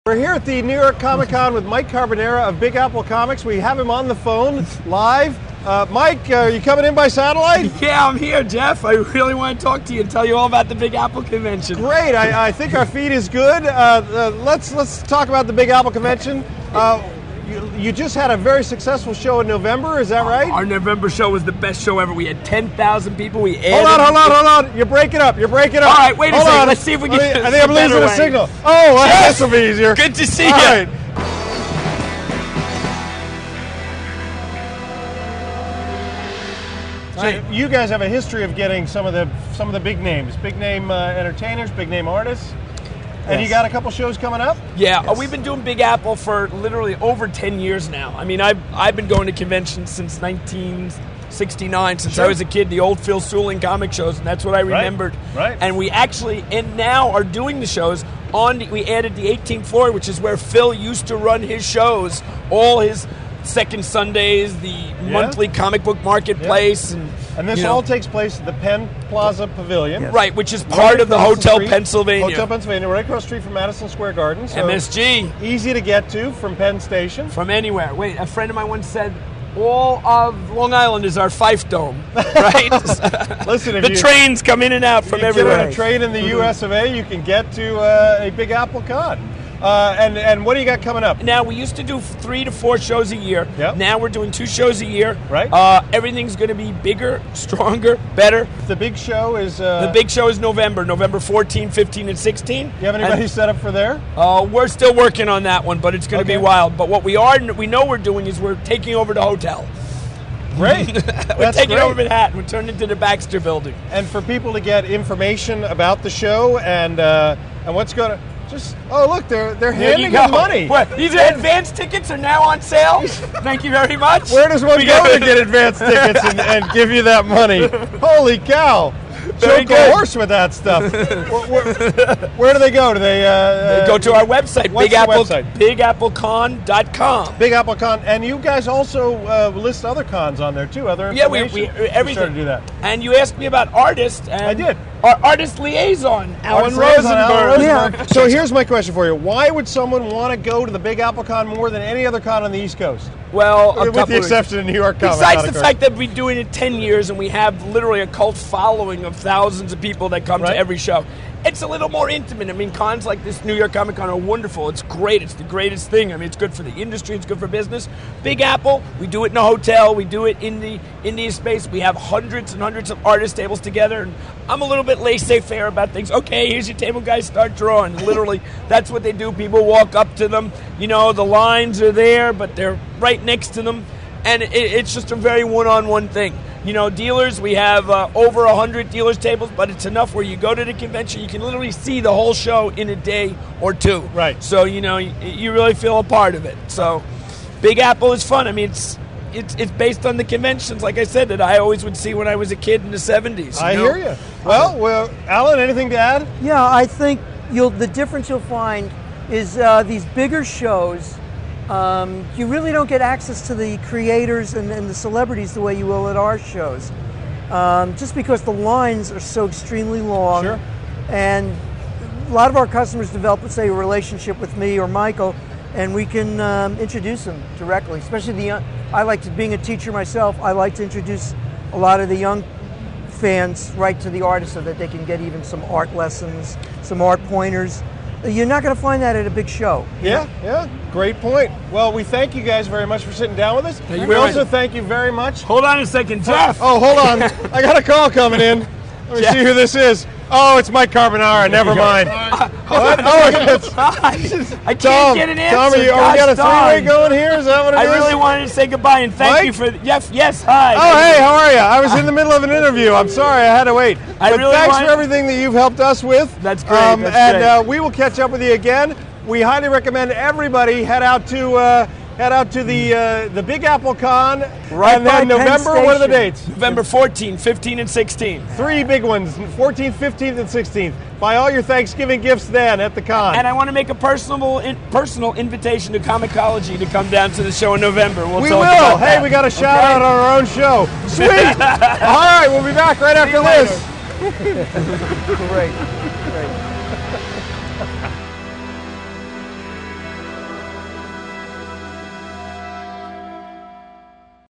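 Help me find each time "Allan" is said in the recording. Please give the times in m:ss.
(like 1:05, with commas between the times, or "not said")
2:26, 3:25.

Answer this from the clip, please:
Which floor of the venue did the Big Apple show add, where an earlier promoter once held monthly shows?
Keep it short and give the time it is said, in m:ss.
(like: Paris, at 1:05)
18th floor, at 0:59.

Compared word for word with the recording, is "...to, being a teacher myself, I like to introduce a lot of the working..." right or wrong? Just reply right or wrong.
wrong.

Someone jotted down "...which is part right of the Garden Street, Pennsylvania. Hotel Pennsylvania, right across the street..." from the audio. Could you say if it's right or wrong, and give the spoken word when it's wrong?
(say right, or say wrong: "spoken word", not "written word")
wrong: "Hotel", not "Garden".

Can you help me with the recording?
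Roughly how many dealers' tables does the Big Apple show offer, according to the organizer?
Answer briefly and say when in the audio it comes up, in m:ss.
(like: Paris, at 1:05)
Over 100, at 3:08.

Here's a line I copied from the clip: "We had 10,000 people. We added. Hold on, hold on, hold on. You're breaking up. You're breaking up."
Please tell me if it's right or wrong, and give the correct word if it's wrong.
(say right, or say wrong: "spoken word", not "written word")
right.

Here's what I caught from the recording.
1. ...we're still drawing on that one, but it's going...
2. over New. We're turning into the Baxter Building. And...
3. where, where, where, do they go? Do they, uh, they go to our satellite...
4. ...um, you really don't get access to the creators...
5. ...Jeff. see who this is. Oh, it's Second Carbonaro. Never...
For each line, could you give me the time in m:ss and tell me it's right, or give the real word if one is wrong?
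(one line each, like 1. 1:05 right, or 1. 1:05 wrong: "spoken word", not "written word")
1. 1:44 wrong: "working", not "drawing"
2. 1:51 wrong: "Manhattan", not "New"
3. 2:10 wrong: "website", not "satellite"
4. 3:31 right
5. 4:09 wrong: "Mike", not "Second".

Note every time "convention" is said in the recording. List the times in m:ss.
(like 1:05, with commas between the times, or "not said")
0:11, 0:15, 0:49, 3:10, 3:20.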